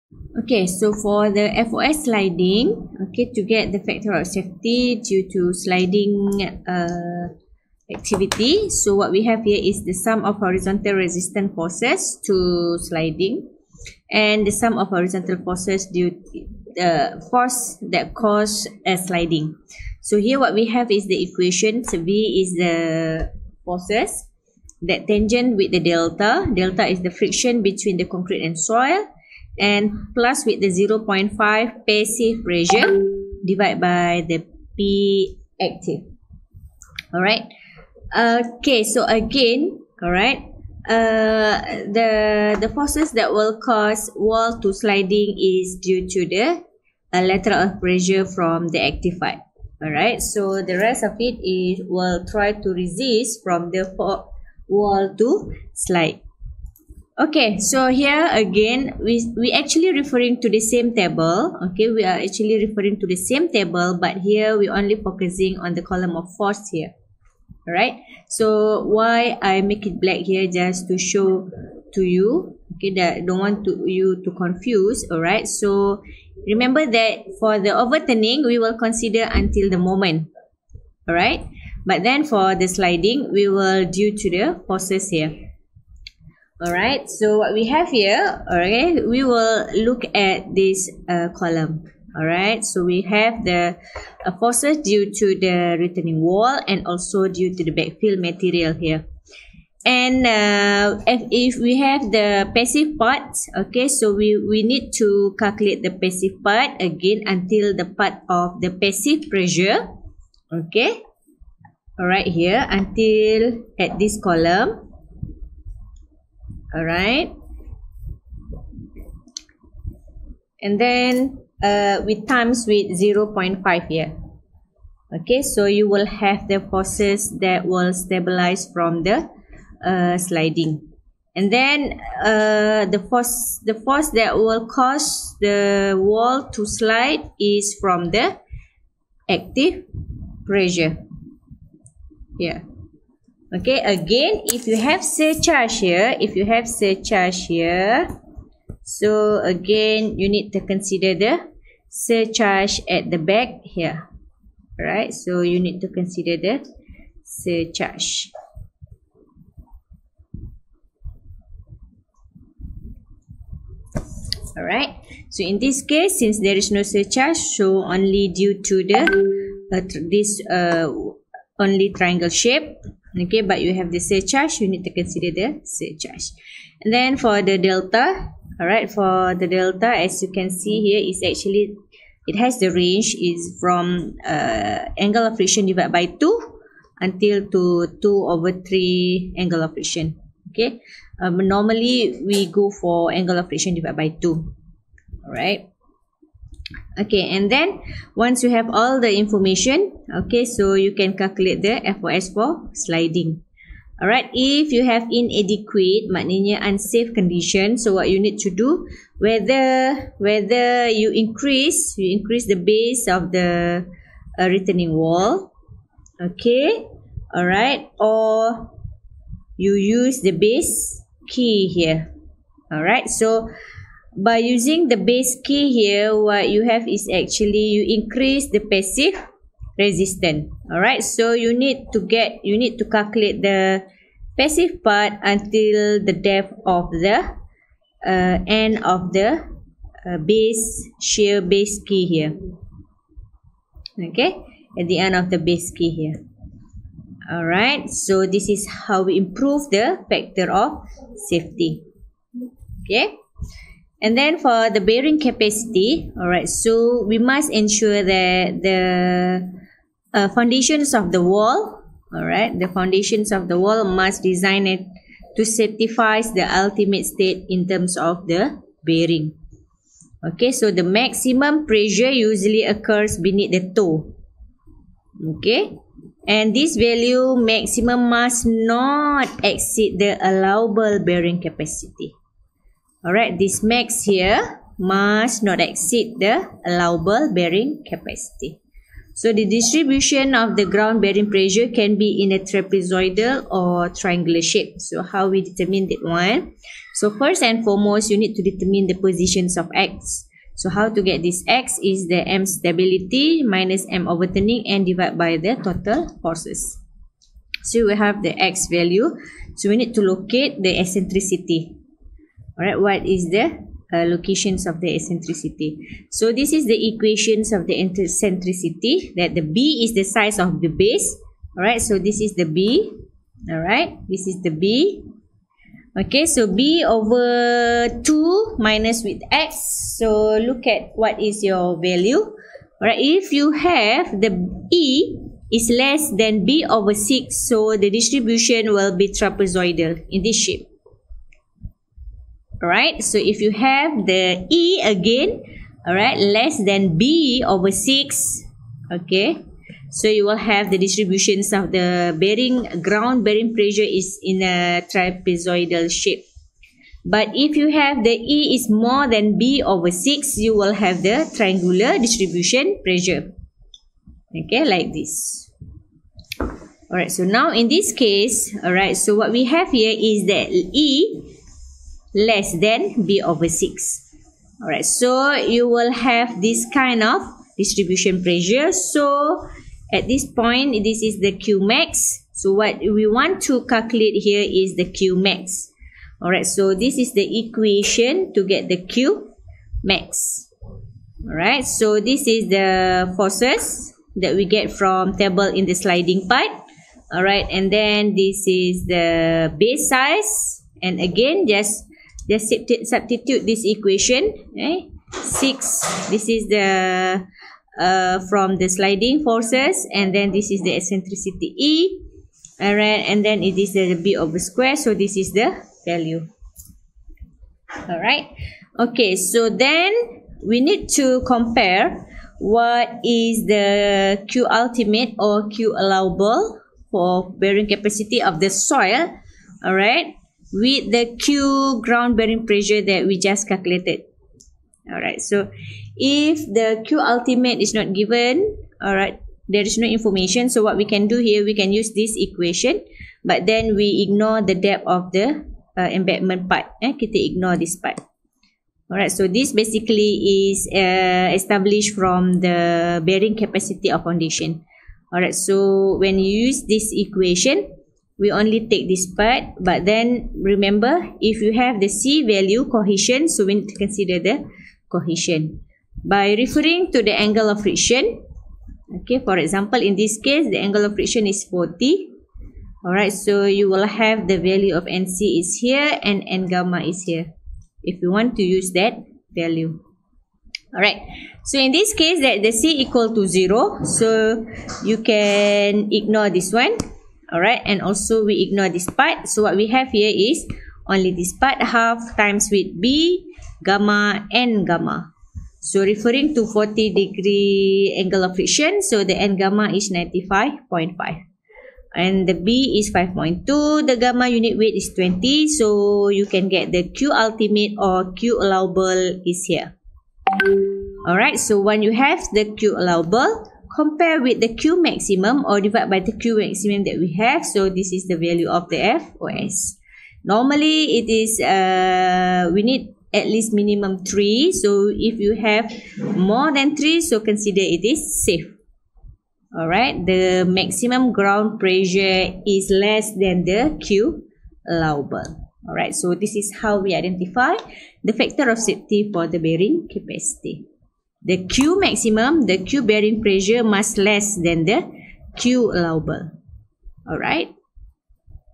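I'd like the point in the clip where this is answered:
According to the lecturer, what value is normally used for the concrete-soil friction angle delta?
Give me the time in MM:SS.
03:13.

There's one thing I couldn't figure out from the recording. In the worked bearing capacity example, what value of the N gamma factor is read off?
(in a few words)
95.5.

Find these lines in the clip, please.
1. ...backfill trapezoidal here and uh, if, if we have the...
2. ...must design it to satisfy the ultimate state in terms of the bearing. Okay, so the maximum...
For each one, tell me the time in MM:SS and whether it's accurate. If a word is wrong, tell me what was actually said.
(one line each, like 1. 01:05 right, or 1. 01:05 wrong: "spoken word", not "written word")
1. 01:37 wrong: "material", not "trapezoidal"
2. 04:23 right.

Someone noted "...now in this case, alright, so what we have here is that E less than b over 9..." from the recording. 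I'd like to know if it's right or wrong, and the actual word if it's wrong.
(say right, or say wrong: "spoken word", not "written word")
wrong: "6", not "9".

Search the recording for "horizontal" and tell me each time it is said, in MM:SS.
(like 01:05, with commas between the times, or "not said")
00:10, 00:14.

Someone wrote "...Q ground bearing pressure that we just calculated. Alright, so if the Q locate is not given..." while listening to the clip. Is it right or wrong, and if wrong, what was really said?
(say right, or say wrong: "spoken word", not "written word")
wrong: "ultimate", not "locate".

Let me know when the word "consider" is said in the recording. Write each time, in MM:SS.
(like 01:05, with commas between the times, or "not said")
01:18, 02:30, 02:35, 02:54, 07:43, 08:47.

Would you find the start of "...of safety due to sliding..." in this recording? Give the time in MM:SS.
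00:04.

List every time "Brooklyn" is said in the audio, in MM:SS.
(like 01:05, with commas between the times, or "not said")
not said.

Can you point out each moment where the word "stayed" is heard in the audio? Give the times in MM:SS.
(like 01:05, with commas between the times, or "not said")
not said.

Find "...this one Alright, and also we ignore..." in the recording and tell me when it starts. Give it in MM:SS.
08:06.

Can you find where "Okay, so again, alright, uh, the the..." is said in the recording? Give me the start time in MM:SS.
00:38.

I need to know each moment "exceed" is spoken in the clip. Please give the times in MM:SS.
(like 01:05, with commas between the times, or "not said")
04:39, 04:45.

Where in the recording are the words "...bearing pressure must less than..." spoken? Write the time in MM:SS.
09:02.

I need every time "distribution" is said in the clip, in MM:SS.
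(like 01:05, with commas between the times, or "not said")
04:49, 05:37, 05:50, 06:01, 06:17.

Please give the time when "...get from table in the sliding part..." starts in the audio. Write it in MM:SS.
06:34.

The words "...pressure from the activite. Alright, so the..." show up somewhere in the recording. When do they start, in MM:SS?
00:47.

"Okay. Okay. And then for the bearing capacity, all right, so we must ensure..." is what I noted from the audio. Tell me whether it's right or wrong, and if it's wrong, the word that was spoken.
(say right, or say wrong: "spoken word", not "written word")
right.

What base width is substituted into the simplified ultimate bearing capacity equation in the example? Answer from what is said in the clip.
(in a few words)
5.2.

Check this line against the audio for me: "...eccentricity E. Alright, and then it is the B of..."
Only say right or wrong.
right.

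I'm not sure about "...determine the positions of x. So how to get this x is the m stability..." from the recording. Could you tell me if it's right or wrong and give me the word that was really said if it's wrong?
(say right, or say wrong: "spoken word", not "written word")
right.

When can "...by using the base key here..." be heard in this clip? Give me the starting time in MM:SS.
03:44.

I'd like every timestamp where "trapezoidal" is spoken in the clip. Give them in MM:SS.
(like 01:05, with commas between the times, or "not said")
04:52, 05:39, 05:54.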